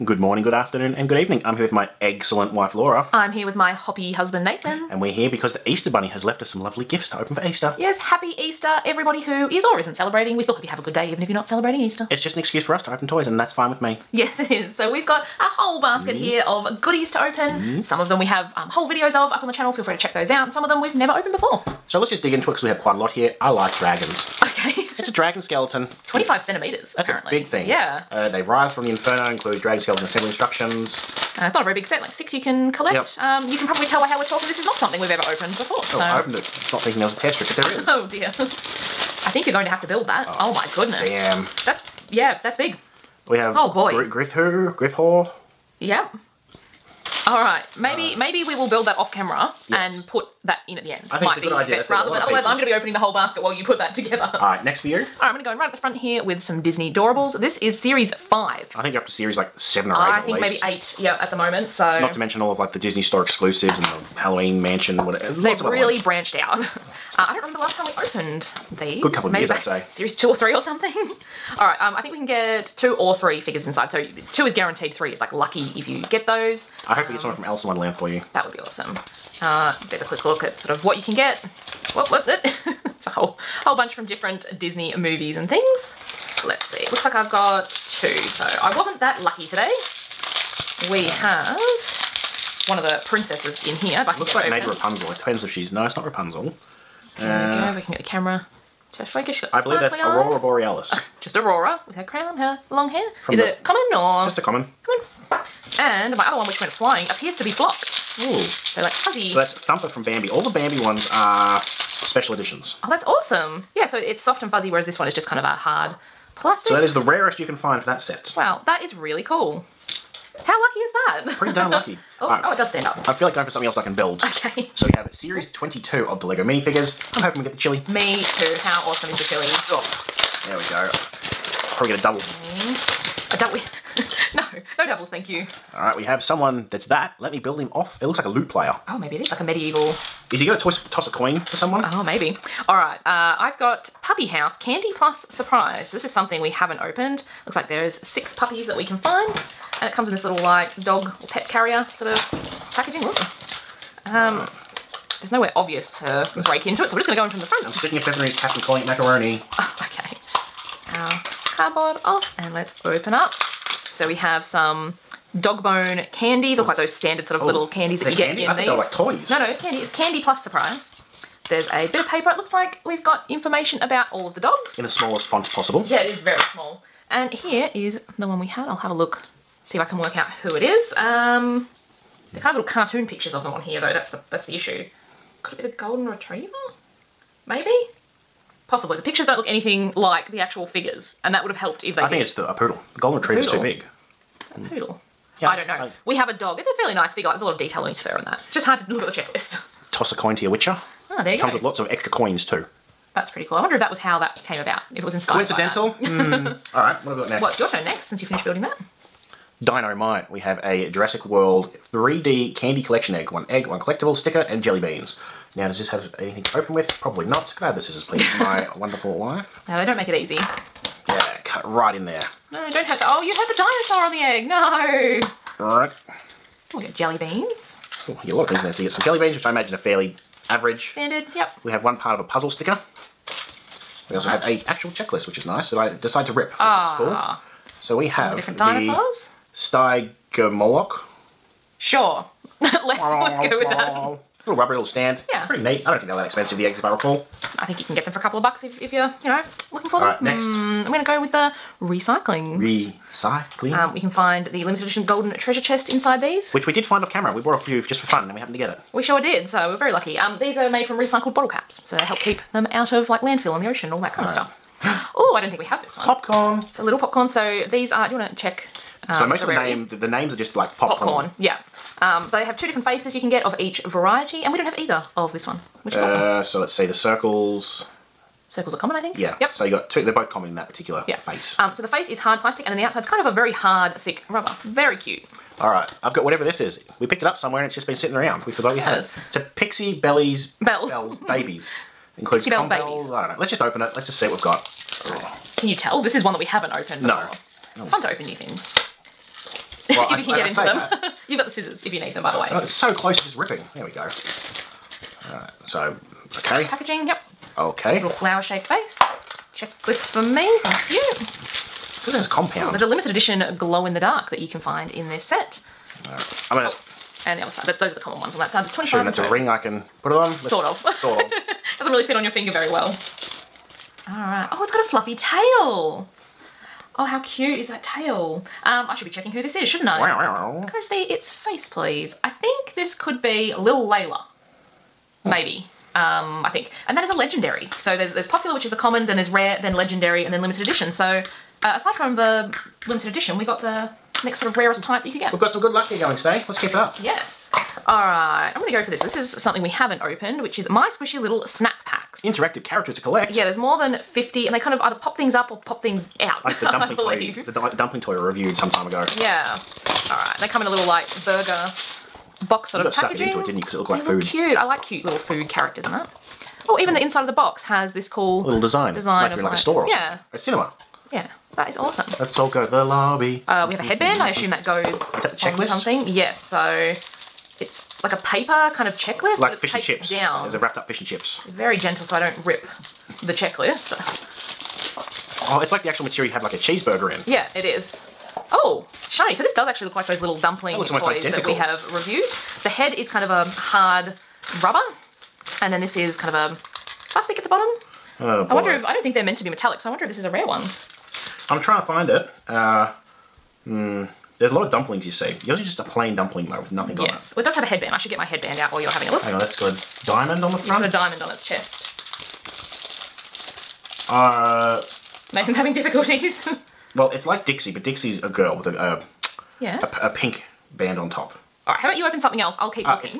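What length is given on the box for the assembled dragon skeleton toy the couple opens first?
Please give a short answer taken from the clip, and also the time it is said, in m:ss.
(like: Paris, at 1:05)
25 centimetres, at 0:26.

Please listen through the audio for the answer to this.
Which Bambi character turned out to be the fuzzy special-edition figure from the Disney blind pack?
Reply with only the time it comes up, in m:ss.
1:49.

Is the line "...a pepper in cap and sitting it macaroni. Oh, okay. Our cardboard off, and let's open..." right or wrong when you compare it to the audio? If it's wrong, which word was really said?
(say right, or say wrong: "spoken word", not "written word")
wrong: "calling", not "sitting".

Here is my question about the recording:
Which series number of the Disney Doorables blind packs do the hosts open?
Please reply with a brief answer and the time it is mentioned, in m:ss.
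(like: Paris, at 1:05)
5, at 0:57.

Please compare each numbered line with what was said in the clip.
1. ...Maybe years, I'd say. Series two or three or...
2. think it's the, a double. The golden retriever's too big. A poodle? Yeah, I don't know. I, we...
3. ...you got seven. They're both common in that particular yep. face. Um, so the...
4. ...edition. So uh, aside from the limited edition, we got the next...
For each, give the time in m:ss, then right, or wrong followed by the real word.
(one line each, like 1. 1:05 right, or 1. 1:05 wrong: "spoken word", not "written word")
1. 1:09 right
2. 3:12 wrong: "poodle", not "double"
3. 4:39 wrong: "two", not "seven"
4. 5:40 right.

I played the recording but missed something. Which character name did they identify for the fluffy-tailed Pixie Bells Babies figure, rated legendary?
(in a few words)
Lil Layla.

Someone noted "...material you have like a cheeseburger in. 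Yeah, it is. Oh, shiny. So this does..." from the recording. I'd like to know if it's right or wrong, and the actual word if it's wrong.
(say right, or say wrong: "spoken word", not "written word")
right.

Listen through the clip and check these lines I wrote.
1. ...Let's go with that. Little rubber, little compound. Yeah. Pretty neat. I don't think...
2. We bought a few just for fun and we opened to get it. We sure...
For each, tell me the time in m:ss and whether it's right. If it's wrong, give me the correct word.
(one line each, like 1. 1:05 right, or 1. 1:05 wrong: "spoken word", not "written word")
1. 4:02 wrong: "stand", not "compound"
2. 4:17 wrong: "happened", not "opened".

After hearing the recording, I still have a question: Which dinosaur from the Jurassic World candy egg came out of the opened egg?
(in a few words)
Stygimoloch.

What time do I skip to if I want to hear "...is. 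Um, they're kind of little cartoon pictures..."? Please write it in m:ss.
3:00.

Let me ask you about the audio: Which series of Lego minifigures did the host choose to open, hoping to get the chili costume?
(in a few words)
22.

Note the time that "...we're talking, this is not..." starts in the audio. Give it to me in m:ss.
0:34.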